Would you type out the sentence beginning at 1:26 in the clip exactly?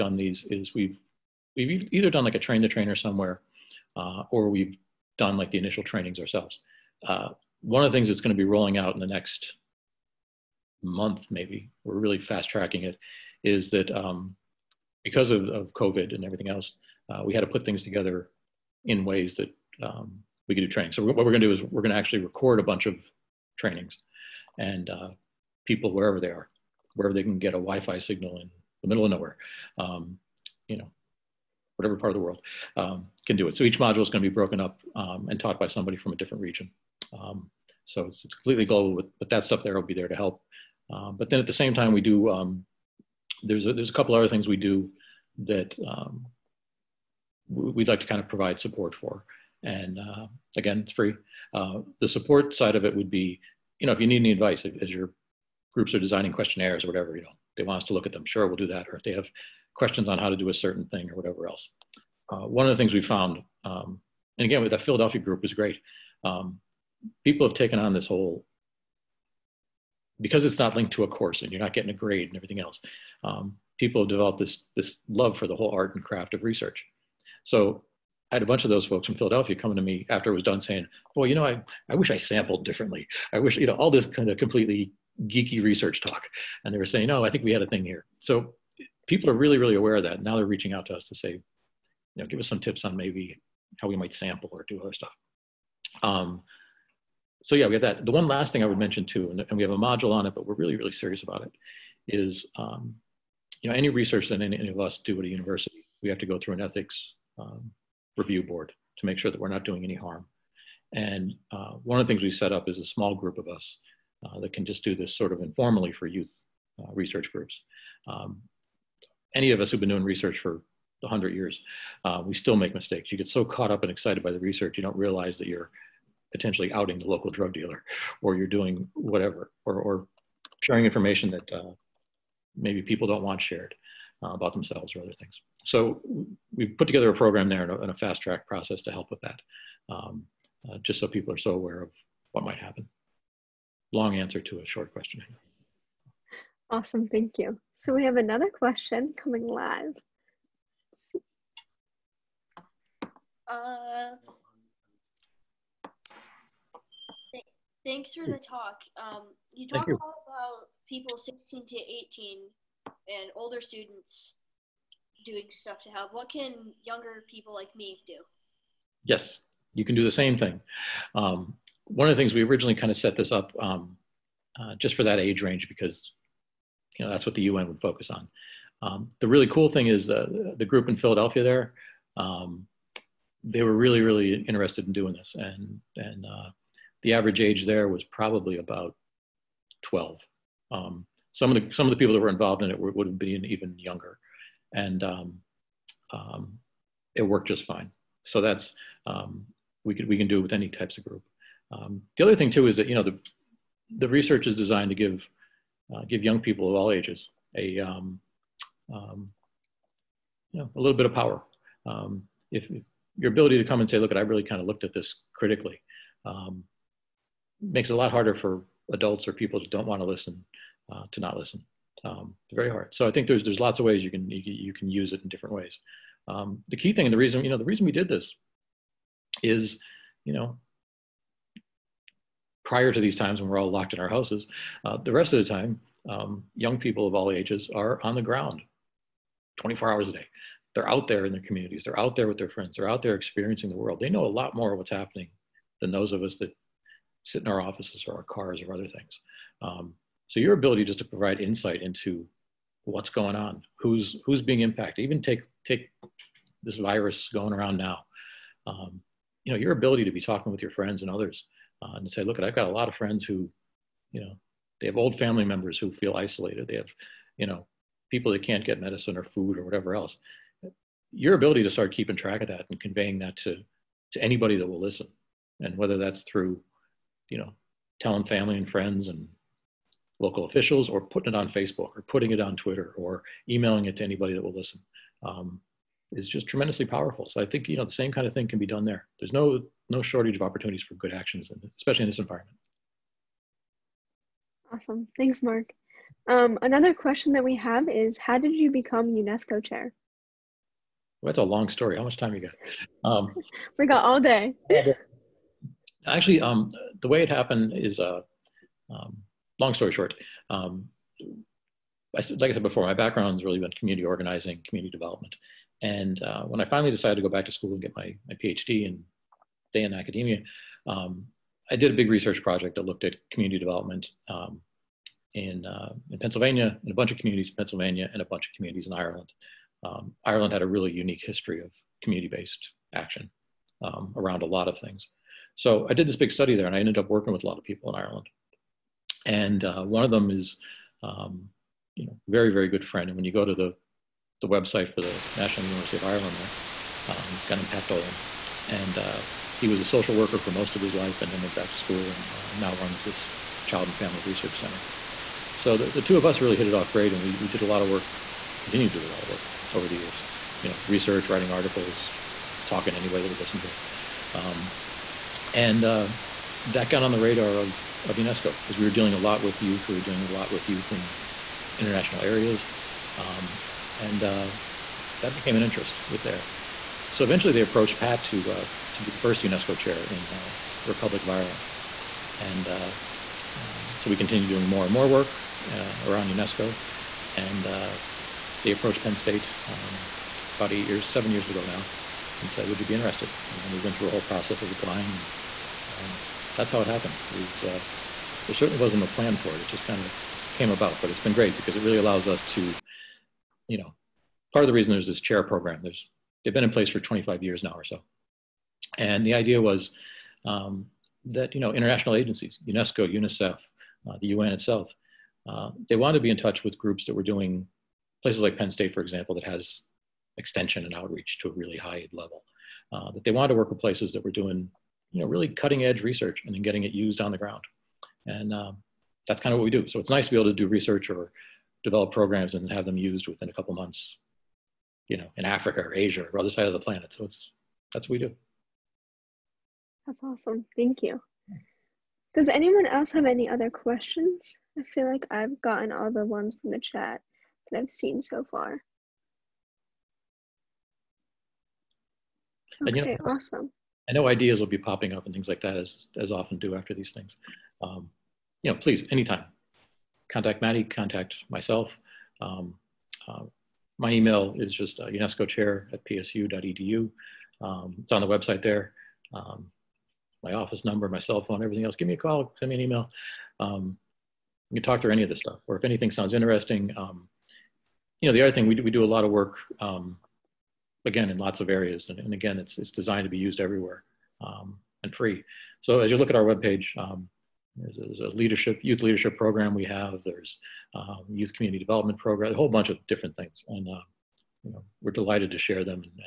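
And they were saying, no, I think we had a thing here.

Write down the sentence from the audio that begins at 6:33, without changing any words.
And then we went through a whole process of applying and um, that's how it happened.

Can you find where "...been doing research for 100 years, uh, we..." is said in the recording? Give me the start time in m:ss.
1:59.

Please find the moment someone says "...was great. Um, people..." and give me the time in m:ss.
1:05.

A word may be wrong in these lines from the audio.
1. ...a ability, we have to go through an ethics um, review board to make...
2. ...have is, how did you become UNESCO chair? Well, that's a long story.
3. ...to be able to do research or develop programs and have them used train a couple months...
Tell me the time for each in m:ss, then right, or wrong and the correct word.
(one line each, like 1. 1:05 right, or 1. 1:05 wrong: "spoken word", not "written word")
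1. 1:45 wrong: "university", not "ability"
2. 4:57 right
3. 7:10 wrong: "within", not "train".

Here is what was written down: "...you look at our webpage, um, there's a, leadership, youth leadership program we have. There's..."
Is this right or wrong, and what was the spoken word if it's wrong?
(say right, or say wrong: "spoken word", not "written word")
right.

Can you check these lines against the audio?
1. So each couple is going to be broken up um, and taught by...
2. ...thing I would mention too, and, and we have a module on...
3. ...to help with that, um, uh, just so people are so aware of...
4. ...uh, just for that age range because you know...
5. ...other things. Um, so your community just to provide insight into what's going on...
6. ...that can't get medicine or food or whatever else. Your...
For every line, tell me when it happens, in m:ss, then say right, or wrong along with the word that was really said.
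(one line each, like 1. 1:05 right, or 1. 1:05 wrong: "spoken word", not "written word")
1. 0:33 wrong: "module", not "couple"
2. 1:38 right
3. 2:18 right
4. 2:54 right
5. 4:08 wrong: "ability", not "community"
6. 4:28 right.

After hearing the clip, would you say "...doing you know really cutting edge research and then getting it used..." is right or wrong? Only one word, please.
right.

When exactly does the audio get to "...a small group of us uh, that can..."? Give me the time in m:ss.
1:52.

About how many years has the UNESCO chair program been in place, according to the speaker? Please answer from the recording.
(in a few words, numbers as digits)
25 years.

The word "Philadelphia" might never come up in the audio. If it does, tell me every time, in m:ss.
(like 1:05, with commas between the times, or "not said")
1:04, 1:19, 3:00.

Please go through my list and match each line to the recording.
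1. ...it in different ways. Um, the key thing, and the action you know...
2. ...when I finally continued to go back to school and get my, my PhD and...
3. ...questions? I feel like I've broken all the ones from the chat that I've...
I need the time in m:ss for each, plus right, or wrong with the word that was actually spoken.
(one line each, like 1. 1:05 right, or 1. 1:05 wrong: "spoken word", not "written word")
1. 3:45 wrong: "reason", not "action"
2. 5:16 wrong: "decided", not "continued"
3. 7:23 wrong: "gotten", not "broken".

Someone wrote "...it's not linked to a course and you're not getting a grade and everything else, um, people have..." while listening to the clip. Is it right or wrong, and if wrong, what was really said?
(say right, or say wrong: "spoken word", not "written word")
right.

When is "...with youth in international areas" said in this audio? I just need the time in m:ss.
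6:10.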